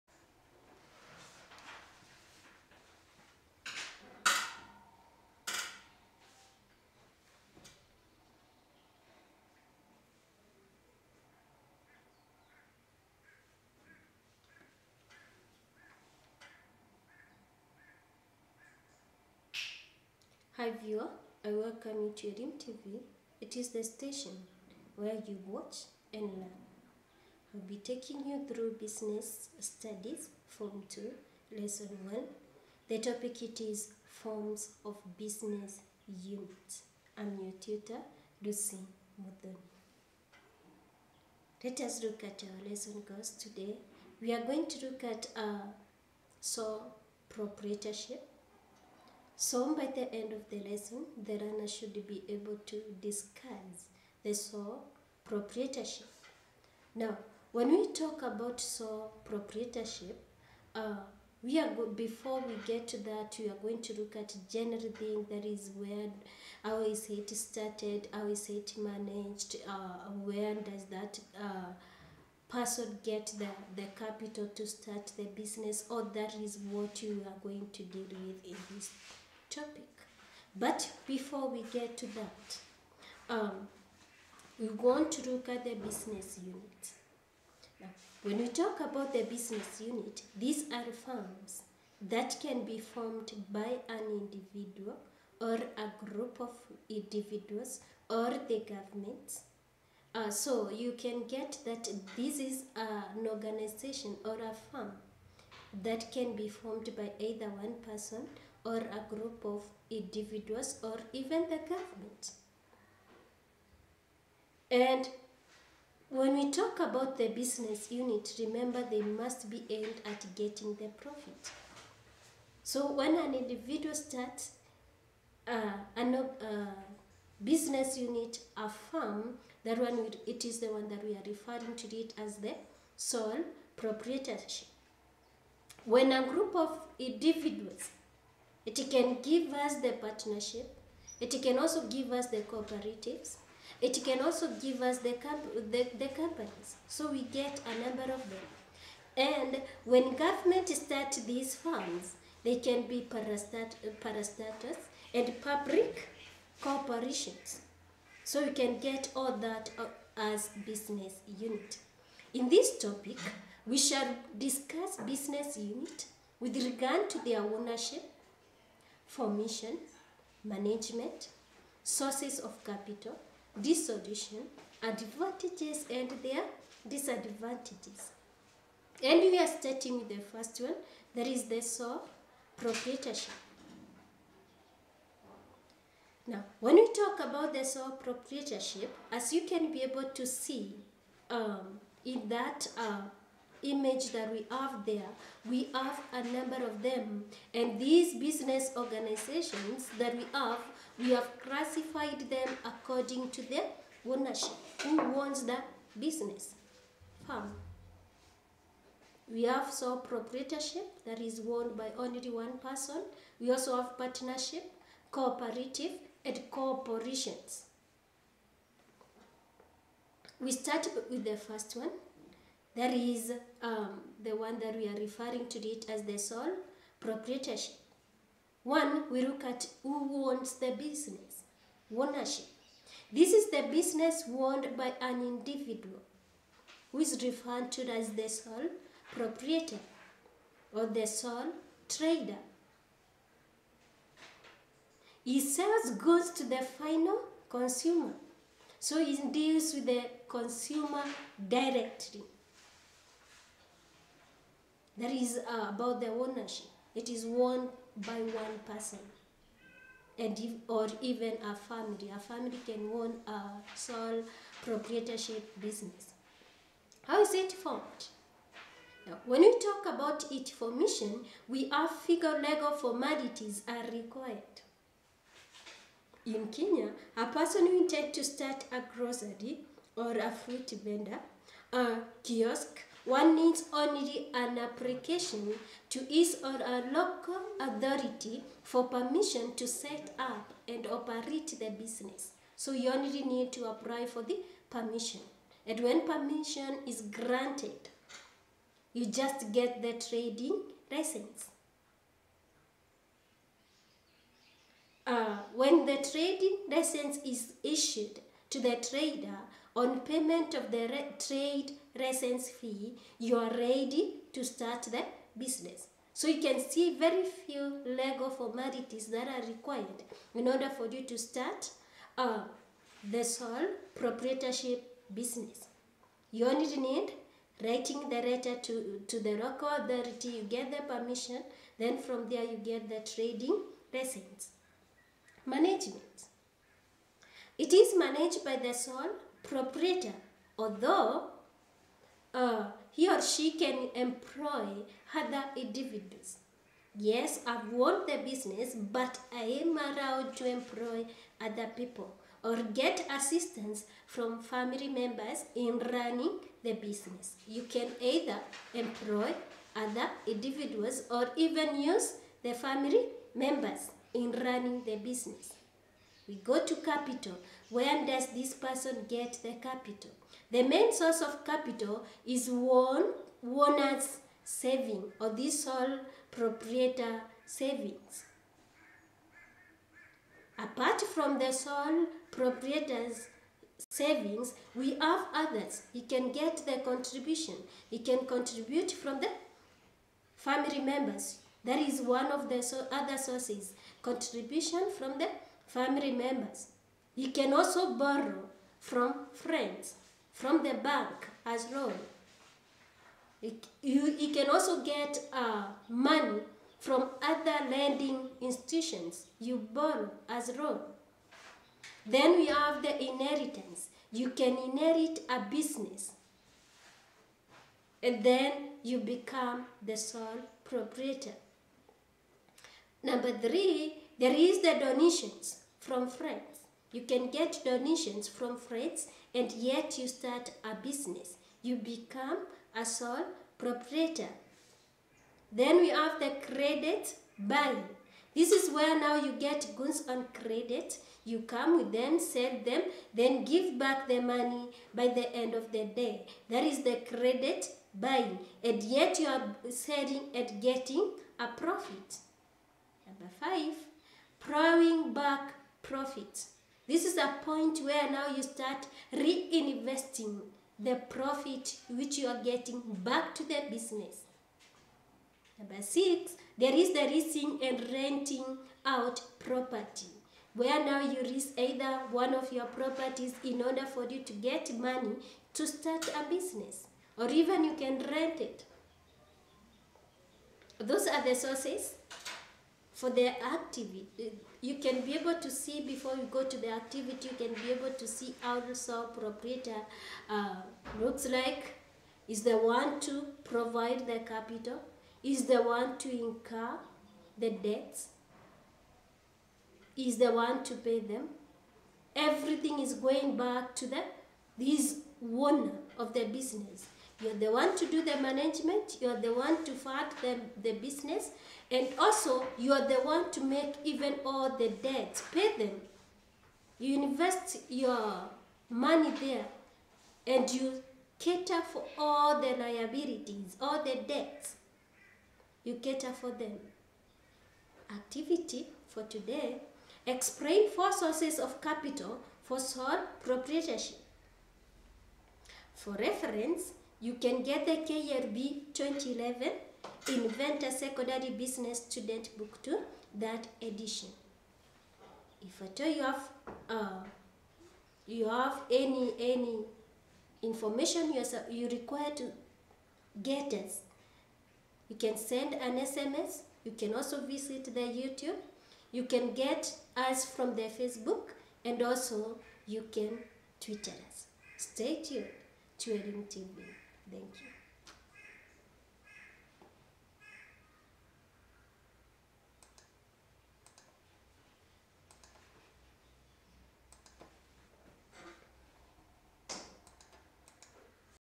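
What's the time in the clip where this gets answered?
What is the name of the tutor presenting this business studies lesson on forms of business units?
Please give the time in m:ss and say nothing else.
0:38.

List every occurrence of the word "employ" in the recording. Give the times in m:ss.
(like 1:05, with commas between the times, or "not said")
5:43, 5:50, 5:58.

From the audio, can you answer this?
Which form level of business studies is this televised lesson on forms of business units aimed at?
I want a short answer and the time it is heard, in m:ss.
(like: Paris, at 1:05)
Form 2, at 0:30.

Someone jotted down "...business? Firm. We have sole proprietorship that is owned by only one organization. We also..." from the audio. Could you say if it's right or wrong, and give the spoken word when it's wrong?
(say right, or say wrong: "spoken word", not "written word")
wrong: "person", not "organization".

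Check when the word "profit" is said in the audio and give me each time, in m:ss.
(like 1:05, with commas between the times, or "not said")
2:00, 7:31, 7:35, 7:41.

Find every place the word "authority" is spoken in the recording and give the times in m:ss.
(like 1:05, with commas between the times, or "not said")
4:47, 5:29.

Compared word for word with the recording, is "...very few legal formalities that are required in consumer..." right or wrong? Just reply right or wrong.
wrong.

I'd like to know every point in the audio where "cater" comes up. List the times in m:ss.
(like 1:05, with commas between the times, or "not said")
8:41, 8:45.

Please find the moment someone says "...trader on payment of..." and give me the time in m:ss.
5:08.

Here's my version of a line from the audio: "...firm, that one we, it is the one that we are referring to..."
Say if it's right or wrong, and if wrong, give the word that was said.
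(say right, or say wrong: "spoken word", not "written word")
right.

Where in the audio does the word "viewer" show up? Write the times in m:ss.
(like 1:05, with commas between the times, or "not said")
0:20.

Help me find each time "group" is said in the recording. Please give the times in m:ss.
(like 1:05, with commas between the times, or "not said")
1:36, 1:49, 2:16.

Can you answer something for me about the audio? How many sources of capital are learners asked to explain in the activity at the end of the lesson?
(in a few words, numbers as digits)
4.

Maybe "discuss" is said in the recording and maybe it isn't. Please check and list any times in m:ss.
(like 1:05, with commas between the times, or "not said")
0:53, 2:44.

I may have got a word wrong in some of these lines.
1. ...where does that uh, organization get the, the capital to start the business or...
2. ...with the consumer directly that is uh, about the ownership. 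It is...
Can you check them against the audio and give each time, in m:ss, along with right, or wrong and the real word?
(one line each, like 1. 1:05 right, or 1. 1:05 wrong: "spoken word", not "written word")
1. 1:10 wrong: "person", not "organization"
2. 4:09 right.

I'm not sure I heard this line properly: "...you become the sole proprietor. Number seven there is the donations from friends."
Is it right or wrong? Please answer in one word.
wrong.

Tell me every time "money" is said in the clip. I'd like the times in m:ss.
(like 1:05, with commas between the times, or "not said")
6:45, 7:24, 7:54, 8:38.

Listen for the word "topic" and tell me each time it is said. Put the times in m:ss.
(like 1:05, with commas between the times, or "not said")
0:32, 1:19, 2:42.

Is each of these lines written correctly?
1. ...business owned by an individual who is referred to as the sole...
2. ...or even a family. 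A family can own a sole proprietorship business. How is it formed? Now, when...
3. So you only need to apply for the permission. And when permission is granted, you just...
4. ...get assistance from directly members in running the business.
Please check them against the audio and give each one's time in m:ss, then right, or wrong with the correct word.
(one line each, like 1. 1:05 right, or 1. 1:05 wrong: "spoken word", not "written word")
1. 3:53 right
2. 4:20 right
3. 4:52 right
4. 5:52 wrong: "family", not "directly".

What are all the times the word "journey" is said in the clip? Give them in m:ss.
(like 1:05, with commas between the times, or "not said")
not said.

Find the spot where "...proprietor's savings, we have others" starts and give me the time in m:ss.
6:22.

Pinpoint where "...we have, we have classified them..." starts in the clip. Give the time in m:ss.
3:20.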